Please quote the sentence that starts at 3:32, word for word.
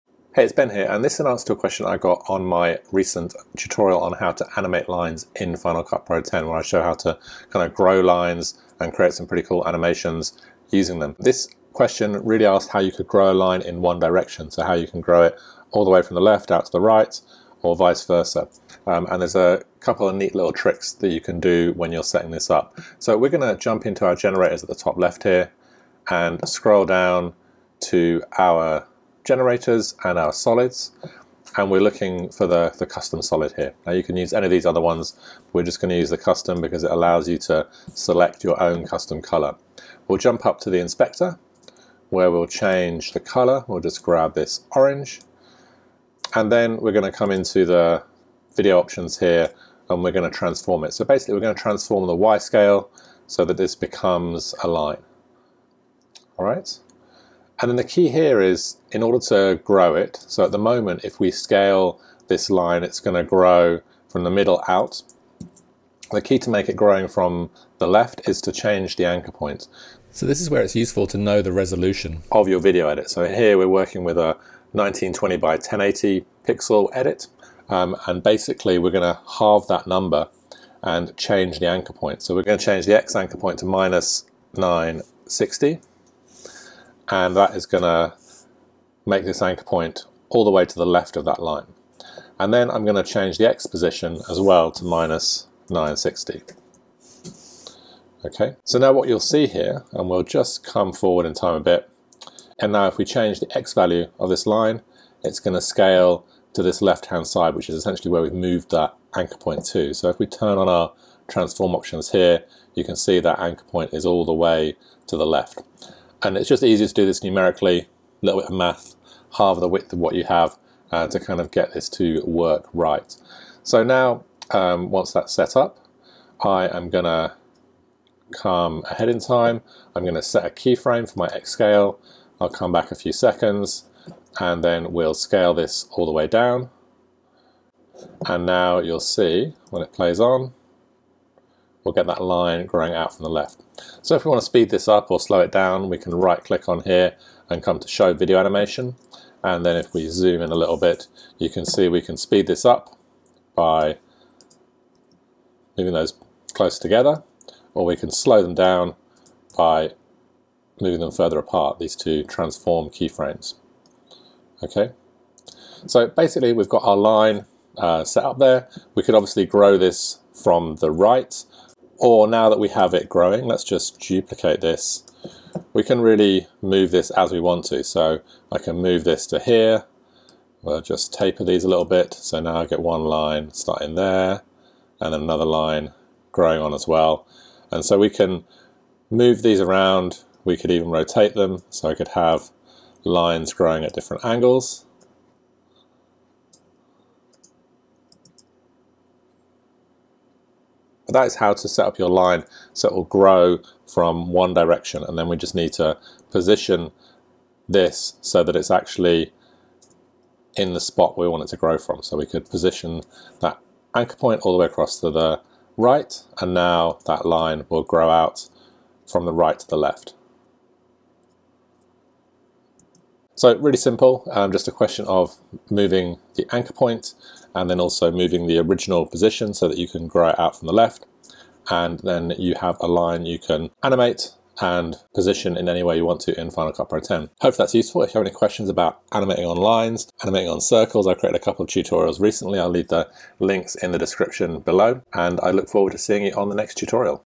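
So we could position that anchor point all the way across to the right.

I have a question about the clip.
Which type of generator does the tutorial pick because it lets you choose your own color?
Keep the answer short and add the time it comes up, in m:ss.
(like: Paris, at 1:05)
Custom solid, at 0:32.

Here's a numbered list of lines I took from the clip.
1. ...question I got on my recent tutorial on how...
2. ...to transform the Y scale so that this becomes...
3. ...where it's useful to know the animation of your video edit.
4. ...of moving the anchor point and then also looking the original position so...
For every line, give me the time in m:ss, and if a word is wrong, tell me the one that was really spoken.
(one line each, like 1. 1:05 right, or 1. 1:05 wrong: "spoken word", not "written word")
1. 0:01 right
2. 0:51 right
3. 1:10 wrong: "resolution", not "animation"
4. 3:45 wrong: "moving", not "looking".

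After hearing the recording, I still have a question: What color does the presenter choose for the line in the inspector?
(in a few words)
Orange.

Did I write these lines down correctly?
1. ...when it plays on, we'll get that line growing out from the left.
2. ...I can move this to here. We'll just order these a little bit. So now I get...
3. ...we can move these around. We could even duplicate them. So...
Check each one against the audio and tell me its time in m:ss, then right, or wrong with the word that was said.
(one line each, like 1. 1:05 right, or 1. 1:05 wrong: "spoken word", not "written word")
1. 2:19 right
2. 2:58 wrong: "taper", not "order"
3. 3:07 wrong: "rotate", not "duplicate".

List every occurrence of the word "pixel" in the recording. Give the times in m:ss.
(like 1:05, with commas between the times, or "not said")
1:16.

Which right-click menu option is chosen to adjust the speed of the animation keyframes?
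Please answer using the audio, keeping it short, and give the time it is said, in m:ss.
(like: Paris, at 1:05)
Show video animation, at 2:27.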